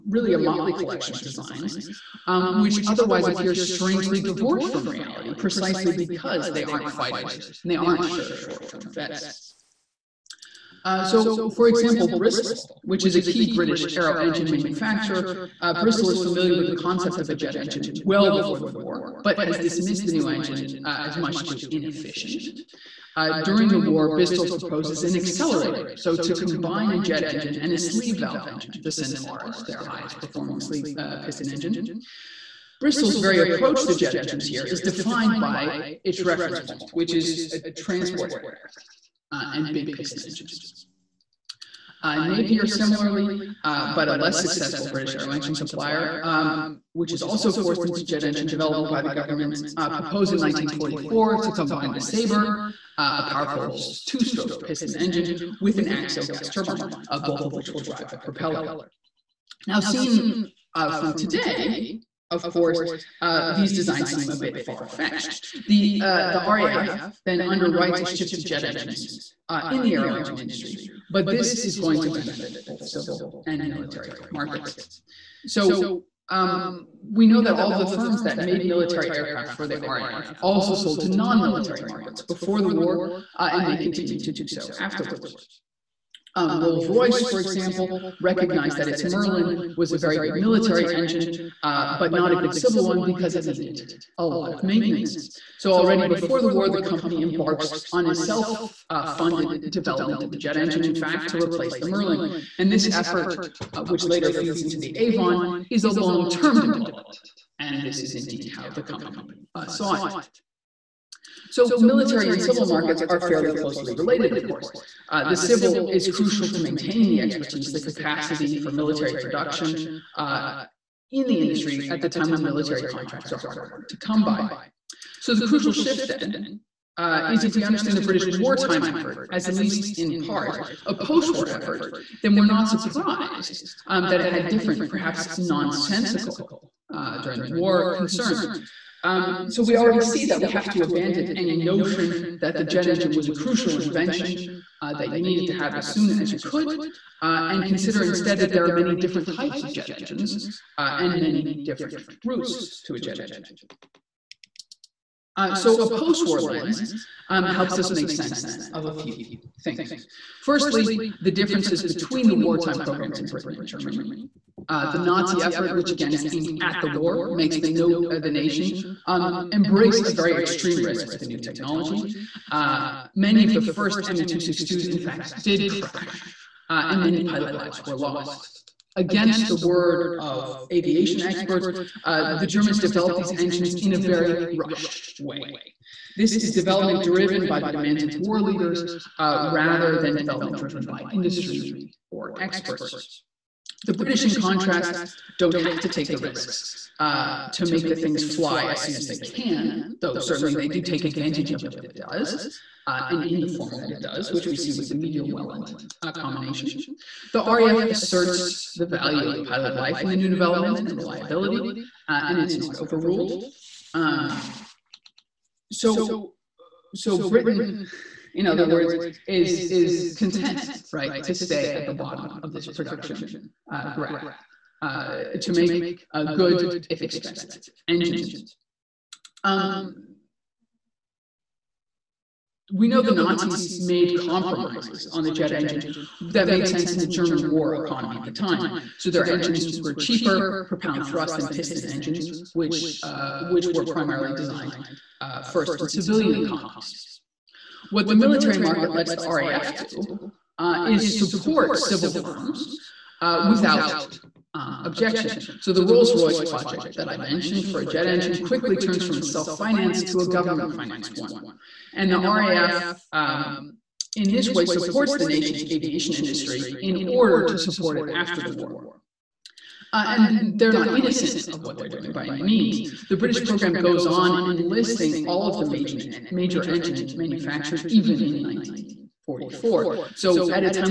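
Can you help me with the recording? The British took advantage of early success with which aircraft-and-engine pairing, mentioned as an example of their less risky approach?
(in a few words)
Meteor Welland.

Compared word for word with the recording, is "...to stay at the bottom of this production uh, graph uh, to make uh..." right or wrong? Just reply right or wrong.
right.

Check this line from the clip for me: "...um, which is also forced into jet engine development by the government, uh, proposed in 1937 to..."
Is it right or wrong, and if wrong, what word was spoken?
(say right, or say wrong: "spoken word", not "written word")
wrong: "1944", not "1937".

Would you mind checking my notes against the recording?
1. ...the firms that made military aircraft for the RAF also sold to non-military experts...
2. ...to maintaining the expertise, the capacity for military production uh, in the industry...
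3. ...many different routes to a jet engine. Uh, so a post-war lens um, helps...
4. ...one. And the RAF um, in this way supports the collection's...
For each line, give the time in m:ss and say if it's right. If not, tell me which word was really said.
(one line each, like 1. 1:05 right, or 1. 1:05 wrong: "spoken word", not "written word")
1. 1:17 wrong: "markets", not "experts"
2. 1:56 right
3. 2:31 right
4. 4:21 wrong: "nation", not "collection".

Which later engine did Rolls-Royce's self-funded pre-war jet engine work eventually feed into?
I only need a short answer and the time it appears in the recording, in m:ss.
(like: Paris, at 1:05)
Avon, at 1:44.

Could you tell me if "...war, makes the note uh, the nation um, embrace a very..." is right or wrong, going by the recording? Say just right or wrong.
right.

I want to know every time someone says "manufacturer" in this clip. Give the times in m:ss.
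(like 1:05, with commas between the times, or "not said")
0:14, 4:37.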